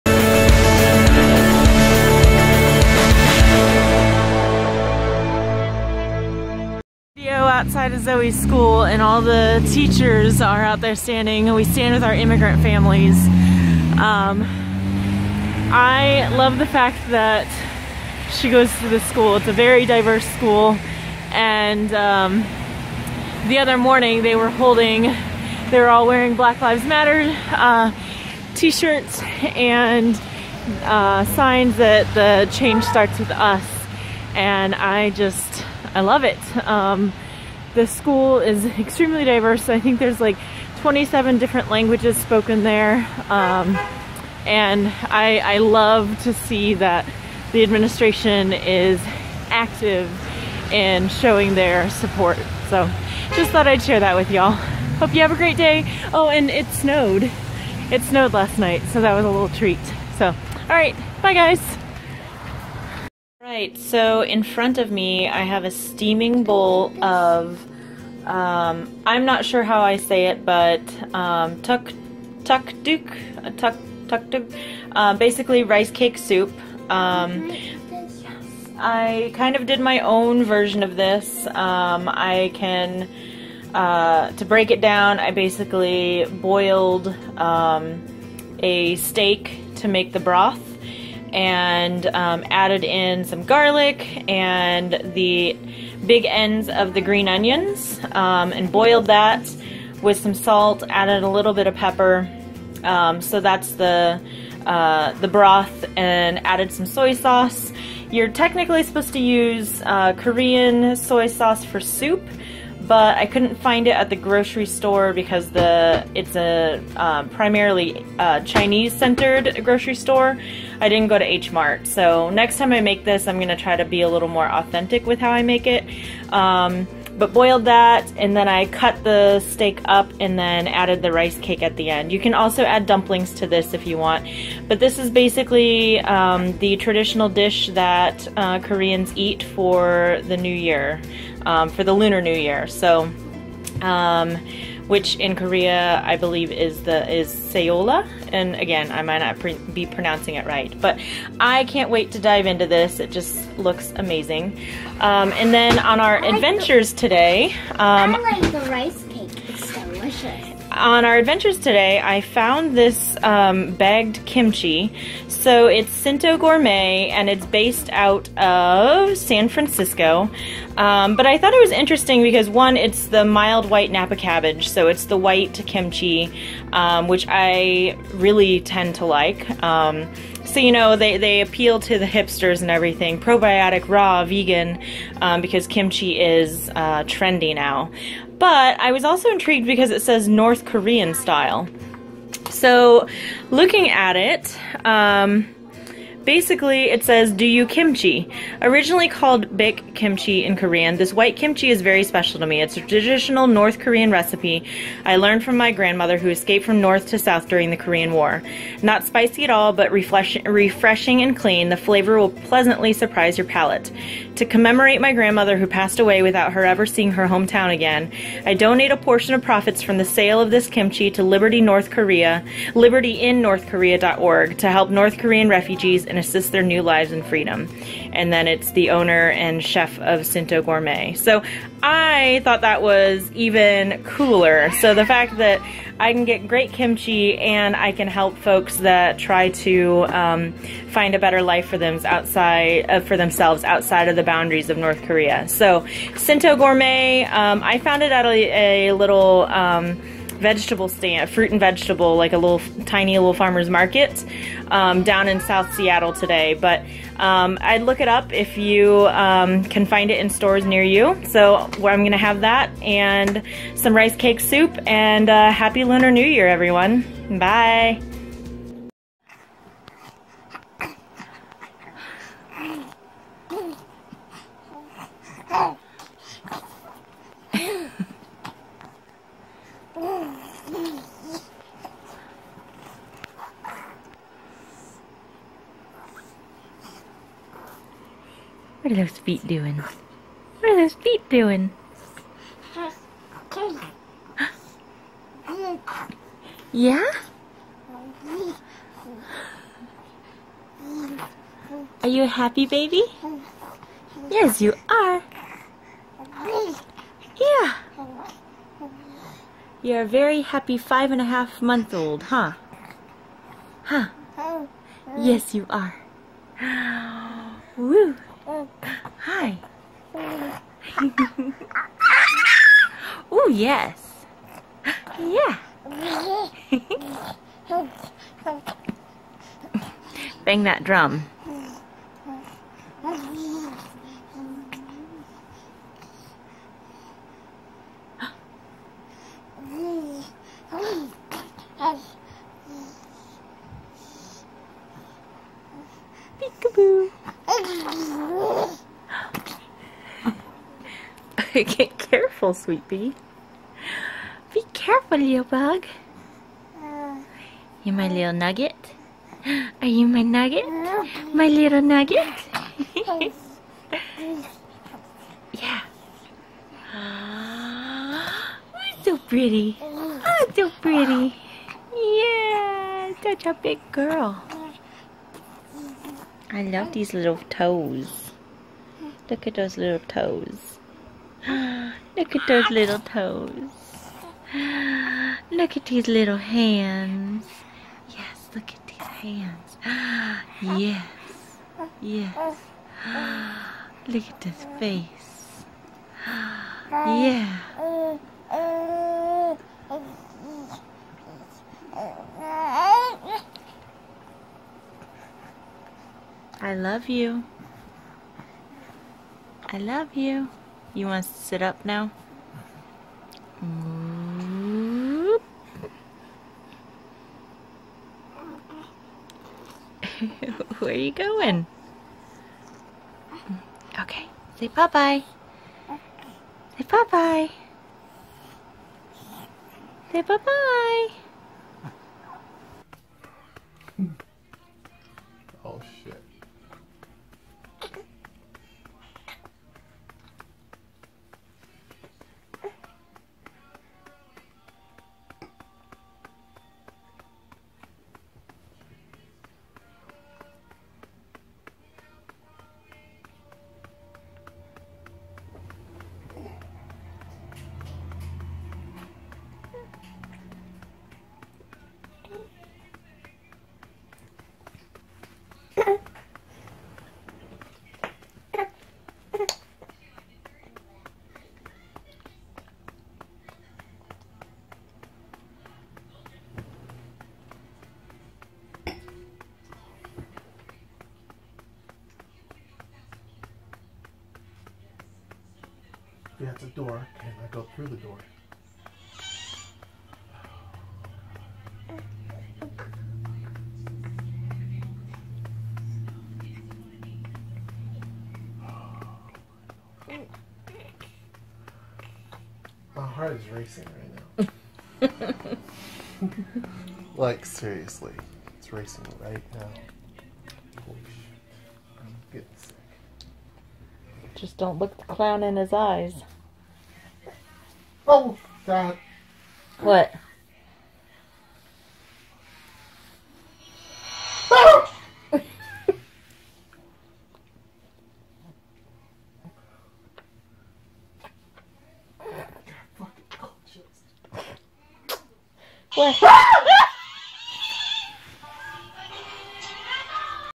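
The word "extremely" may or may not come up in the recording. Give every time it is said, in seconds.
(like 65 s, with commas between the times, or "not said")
38 s.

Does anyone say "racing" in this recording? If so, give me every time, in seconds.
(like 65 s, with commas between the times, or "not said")
503 s, 508 s.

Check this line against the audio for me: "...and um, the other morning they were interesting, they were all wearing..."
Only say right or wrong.
wrong.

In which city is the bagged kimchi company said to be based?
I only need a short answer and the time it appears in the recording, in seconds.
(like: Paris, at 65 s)
San Francisco, at 169 s.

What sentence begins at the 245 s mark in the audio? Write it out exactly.
So Sinto Gourmet, um, I found it at a, a little.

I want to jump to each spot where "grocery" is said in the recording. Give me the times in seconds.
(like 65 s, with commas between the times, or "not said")
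114 s, 119 s.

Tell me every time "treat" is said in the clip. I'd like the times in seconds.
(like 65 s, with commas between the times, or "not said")
59 s.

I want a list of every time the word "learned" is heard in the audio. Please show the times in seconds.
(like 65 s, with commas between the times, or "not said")
205 s.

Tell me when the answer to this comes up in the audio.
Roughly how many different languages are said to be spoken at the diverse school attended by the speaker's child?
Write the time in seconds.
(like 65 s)
40 s.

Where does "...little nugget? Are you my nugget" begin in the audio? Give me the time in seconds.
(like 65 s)
358 s.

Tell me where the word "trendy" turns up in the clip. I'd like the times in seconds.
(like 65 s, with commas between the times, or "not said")
187 s.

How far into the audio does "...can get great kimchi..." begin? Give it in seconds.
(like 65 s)
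236 s.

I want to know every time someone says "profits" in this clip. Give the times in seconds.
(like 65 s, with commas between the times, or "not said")
219 s.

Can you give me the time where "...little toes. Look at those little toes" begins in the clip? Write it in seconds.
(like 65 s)
377 s.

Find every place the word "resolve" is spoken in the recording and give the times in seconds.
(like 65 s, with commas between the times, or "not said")
not said.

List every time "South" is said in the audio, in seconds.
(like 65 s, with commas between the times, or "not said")
207 s, 255 s.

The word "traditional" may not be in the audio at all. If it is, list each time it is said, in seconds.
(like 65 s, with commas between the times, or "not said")
136 s, 202 s.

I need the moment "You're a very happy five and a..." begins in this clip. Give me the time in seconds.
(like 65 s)
309 s.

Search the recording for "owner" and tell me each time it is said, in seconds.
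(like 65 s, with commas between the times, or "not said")
228 s.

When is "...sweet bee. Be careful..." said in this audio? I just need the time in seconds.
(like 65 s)
352 s.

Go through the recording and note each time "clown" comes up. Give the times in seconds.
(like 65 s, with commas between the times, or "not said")
515 s.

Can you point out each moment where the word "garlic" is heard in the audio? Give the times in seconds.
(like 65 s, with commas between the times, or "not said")
93 s.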